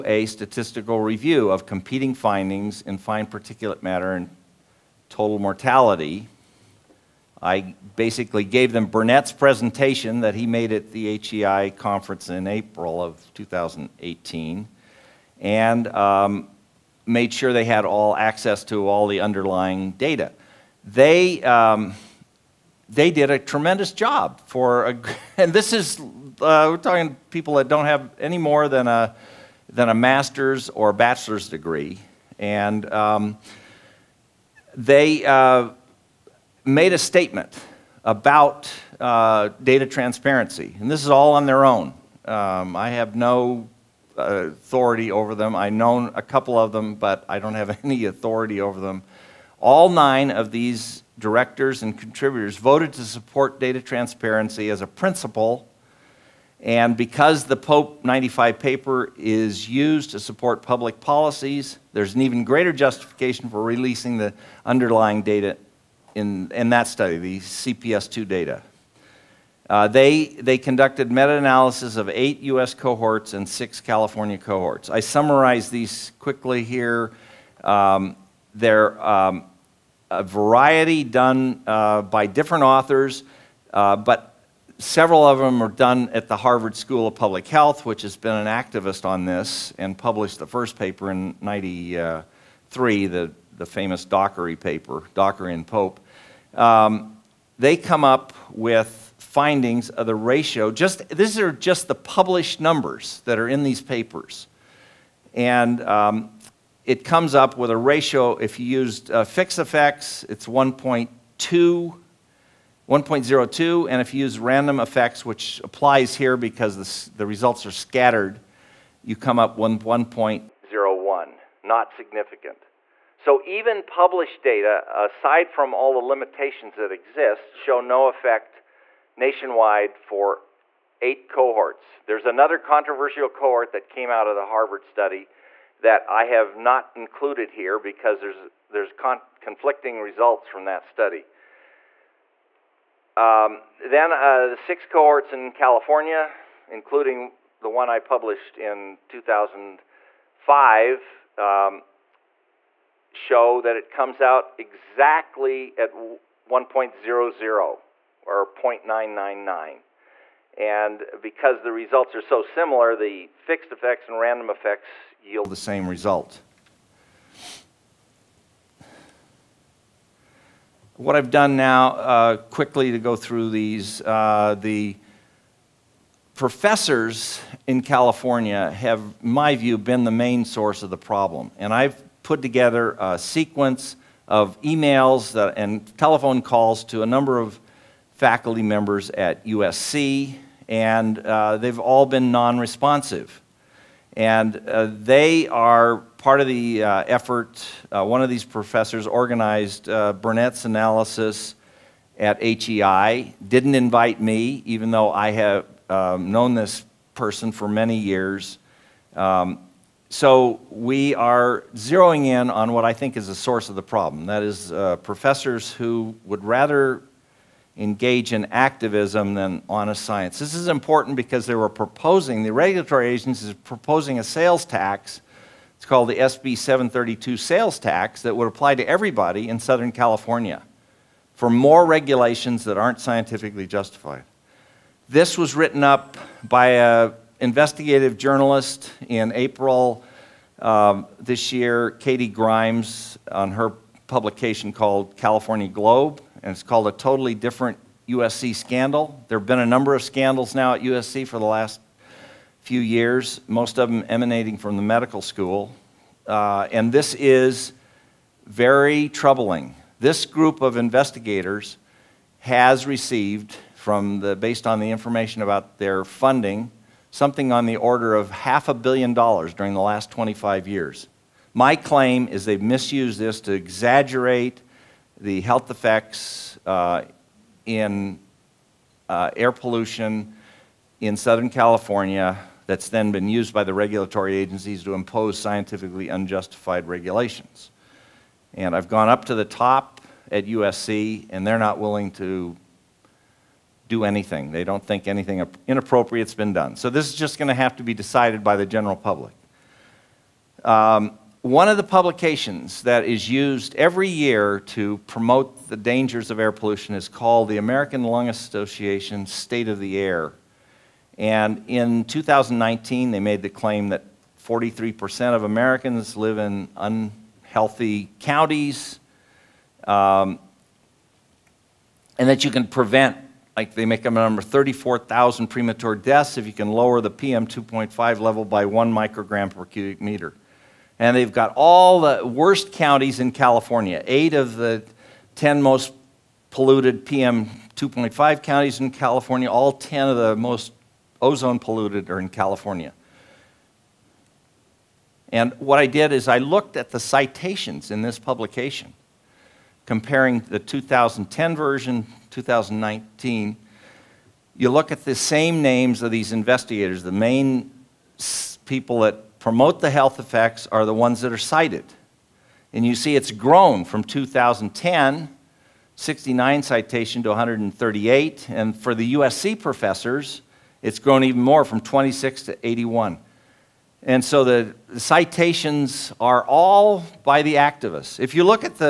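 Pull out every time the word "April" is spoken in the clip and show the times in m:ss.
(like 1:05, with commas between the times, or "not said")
0:12, 3:59.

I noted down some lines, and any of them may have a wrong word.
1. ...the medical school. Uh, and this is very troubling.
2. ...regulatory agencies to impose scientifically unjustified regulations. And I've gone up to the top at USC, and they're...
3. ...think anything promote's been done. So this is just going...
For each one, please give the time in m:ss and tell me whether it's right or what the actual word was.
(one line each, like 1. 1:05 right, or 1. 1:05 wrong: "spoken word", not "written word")
1. 4:14 right
2. 4:43 right
3. 4:54 wrong: "inappropriate", not "promote".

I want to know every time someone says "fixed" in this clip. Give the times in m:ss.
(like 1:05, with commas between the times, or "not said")
1:49, 2:43.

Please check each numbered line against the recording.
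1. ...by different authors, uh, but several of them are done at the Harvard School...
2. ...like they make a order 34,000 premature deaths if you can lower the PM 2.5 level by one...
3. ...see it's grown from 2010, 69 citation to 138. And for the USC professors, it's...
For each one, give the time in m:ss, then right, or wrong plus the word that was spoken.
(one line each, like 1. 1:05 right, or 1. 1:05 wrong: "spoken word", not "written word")
1. 1:22 right
2. 5:23 wrong: "number", not "order"
3. 6:02 right.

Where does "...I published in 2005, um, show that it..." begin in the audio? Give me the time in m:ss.
2:27.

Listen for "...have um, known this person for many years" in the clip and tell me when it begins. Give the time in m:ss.
3:25.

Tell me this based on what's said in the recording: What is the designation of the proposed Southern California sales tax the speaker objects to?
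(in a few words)
SB 732.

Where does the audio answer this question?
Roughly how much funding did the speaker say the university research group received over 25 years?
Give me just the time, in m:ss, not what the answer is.
4:28.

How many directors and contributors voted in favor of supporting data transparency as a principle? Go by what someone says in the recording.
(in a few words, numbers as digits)
9.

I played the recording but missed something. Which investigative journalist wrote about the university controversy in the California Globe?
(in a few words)
Katie Grimes.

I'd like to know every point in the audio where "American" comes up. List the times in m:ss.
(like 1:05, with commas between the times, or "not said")
5:07, 5:15.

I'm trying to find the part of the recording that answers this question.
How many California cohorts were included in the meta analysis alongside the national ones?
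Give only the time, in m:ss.
1:13.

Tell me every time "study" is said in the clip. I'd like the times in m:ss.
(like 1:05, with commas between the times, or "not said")
1:06, 2:14, 2:20.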